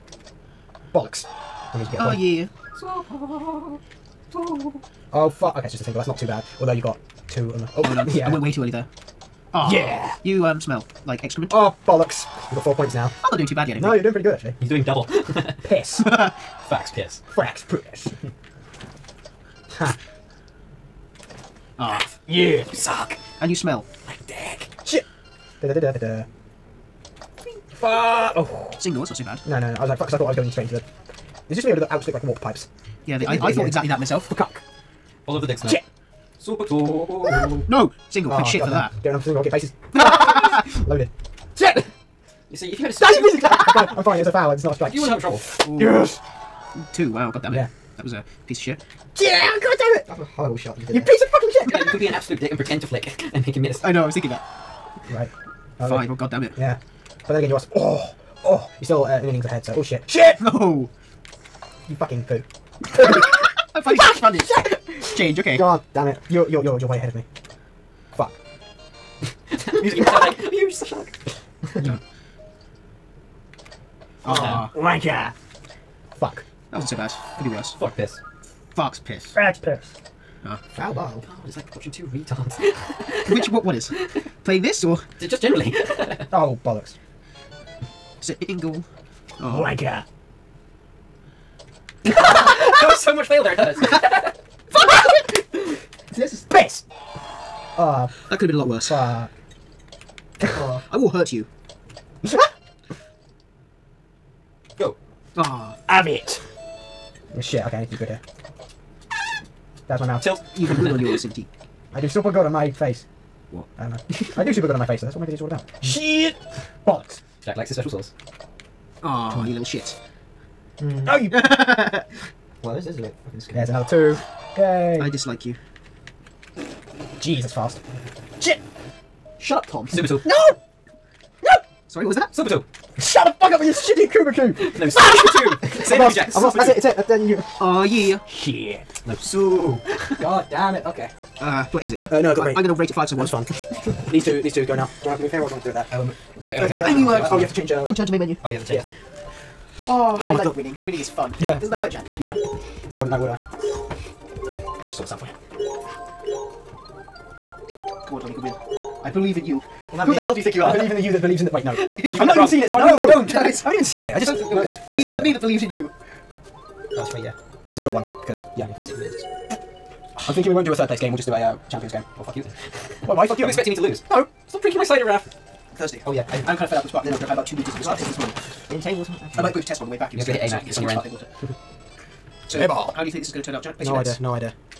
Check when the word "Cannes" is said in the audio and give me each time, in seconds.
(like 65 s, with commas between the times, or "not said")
not said.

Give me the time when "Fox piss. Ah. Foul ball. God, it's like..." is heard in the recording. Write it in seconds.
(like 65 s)
79 s.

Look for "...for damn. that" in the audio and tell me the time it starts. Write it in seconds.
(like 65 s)
38 s.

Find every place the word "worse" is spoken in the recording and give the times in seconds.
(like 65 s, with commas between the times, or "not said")
77 s, 98 s.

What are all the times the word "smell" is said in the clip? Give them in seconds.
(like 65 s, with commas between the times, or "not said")
10 s, 23 s.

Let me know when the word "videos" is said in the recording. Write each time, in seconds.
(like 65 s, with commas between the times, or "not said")
115 s.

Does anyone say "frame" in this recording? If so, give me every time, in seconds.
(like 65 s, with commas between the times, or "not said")
not said.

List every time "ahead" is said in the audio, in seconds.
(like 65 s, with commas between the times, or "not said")
59 s, 66 s.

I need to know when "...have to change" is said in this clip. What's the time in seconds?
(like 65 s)
147 s.